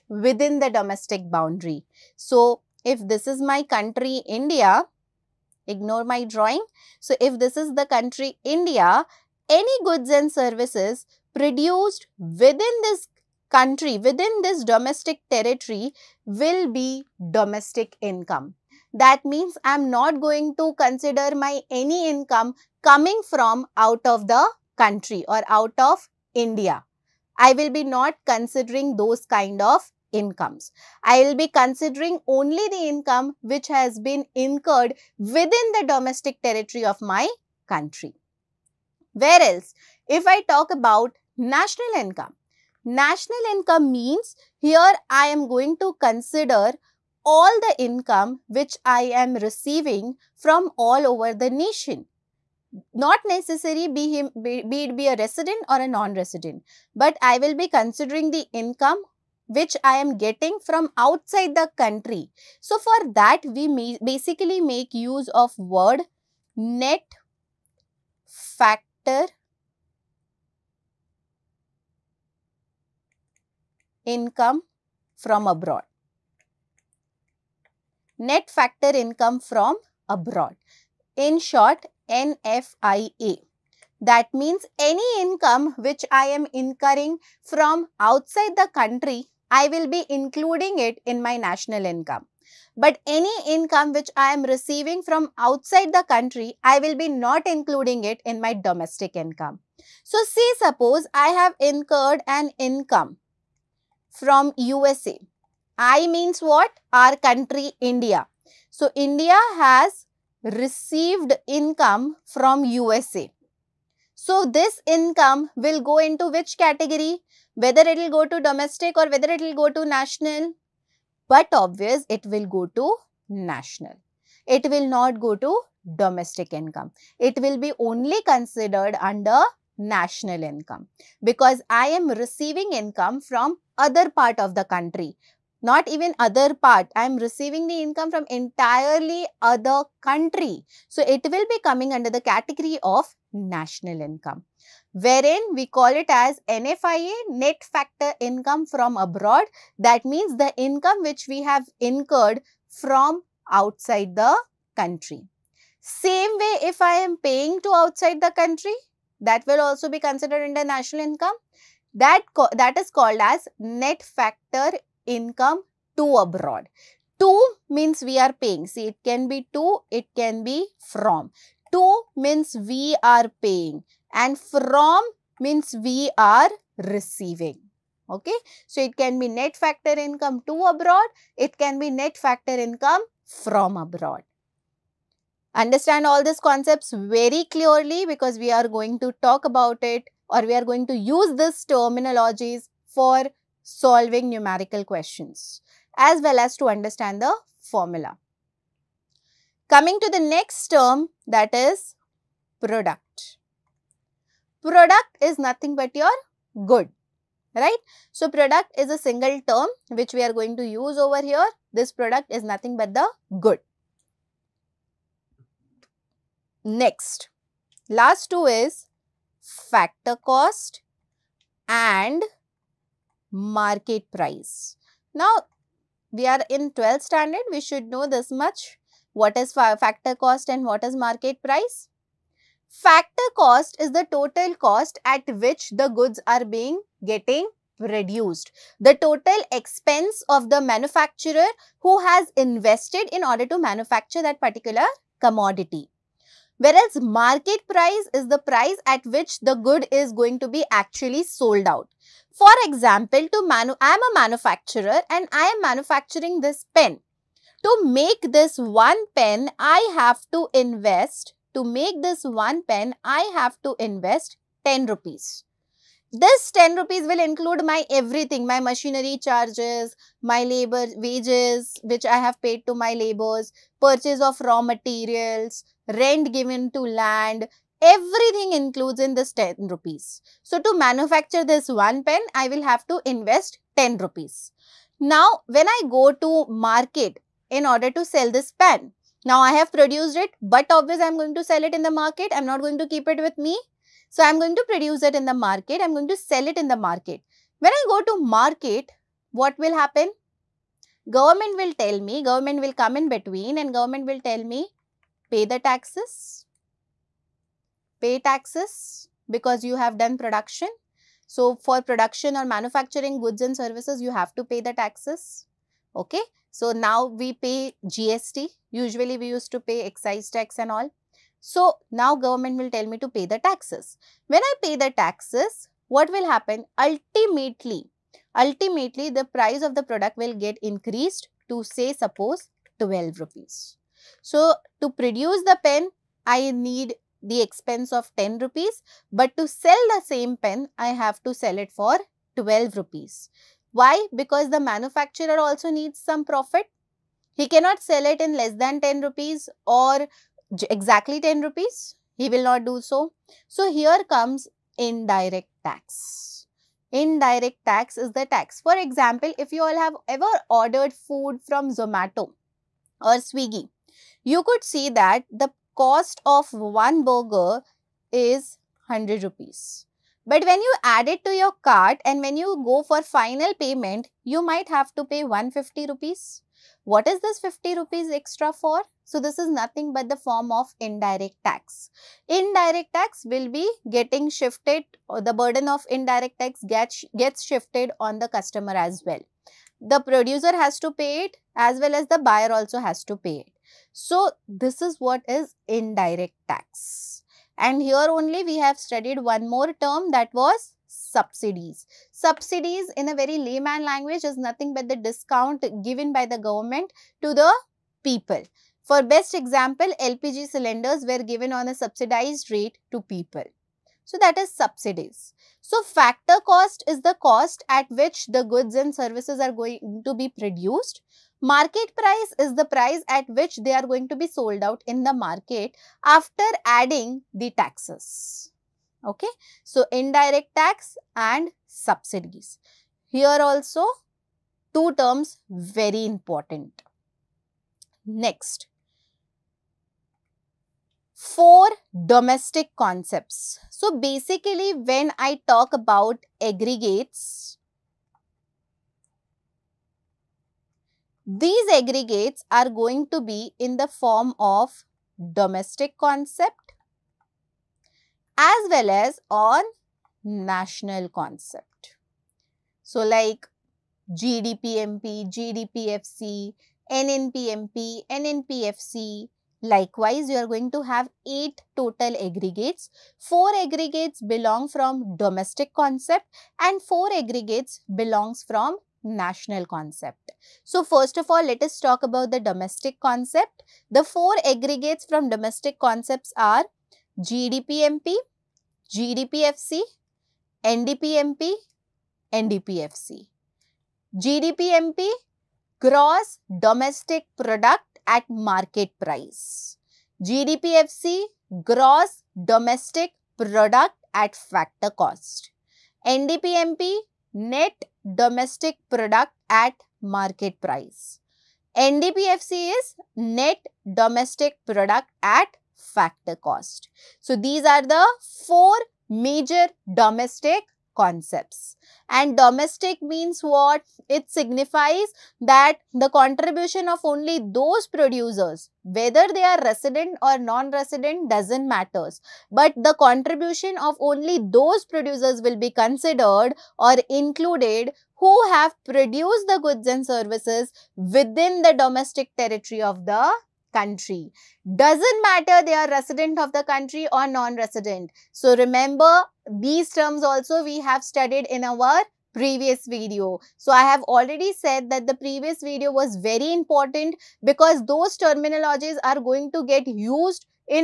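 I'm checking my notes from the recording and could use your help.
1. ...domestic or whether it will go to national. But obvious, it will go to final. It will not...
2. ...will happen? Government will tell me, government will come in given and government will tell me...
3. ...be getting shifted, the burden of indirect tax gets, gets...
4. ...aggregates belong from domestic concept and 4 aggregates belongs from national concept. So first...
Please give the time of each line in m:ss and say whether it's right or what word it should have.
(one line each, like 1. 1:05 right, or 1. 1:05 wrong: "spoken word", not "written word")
1. 1:58 wrong: "national", not "final"
2. 4:59 wrong: "between", not "given"
3. 6:23 right
4. 7:53 right.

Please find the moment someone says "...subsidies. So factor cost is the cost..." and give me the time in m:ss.
6:54.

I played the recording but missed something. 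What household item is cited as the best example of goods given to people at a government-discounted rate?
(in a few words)
LPG cylinders.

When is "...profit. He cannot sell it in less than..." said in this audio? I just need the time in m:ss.
5:46.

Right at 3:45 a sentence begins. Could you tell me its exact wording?
Now, we are in 12th standard, we should know this much.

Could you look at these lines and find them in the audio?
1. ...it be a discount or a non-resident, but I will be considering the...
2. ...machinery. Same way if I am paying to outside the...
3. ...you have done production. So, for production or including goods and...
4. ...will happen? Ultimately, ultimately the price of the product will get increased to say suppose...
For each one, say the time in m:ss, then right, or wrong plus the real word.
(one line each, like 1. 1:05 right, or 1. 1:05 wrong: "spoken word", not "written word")
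1. 0:54 wrong: "resident", not "discount"
2. 2:34 wrong: "country", not "machinery"
3. 5:09 wrong: "manufacturing", not "including"
4. 5:26 right.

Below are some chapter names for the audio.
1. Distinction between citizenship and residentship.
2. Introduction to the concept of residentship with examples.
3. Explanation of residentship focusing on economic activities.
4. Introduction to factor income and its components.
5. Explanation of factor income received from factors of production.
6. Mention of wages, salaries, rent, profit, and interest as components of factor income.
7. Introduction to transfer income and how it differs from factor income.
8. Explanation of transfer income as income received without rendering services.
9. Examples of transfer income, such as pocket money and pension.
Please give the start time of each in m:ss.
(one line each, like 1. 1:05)
1. 0:54
2. 1:46
3. 2:31
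4. 3:16
5. 4:10
6. 4:56
7. 5:36
8. 6:18
9. 7:00.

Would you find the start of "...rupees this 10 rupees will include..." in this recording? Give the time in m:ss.
4:24.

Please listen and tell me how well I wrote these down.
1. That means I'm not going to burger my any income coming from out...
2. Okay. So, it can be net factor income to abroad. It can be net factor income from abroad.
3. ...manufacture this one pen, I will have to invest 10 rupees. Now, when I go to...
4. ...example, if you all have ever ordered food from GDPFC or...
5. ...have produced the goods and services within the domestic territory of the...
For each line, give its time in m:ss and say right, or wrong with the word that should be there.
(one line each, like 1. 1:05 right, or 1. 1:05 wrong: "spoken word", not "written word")
1. 0:18 wrong: "consider", not "burger"
2. 2:58 right
3. 4:40 right
4. 5:58 wrong: "Zomato", not "GDPFC"
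5. 8:58 right.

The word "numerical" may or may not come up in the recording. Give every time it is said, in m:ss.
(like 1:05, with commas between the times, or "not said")
3:14.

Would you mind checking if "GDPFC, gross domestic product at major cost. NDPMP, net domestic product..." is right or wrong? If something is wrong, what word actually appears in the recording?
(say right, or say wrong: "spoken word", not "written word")
wrong: "factor", not "major".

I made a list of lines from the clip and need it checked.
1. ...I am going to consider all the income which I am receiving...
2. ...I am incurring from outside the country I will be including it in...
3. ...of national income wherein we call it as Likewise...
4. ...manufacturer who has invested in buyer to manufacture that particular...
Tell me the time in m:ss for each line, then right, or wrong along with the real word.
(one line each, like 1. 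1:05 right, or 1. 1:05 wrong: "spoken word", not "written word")
1. 0:45 right
2. 1:26 right
3. 2:22 wrong: "NFIA", not "Likewise"
4. 4:00 wrong: "order", not "buyer".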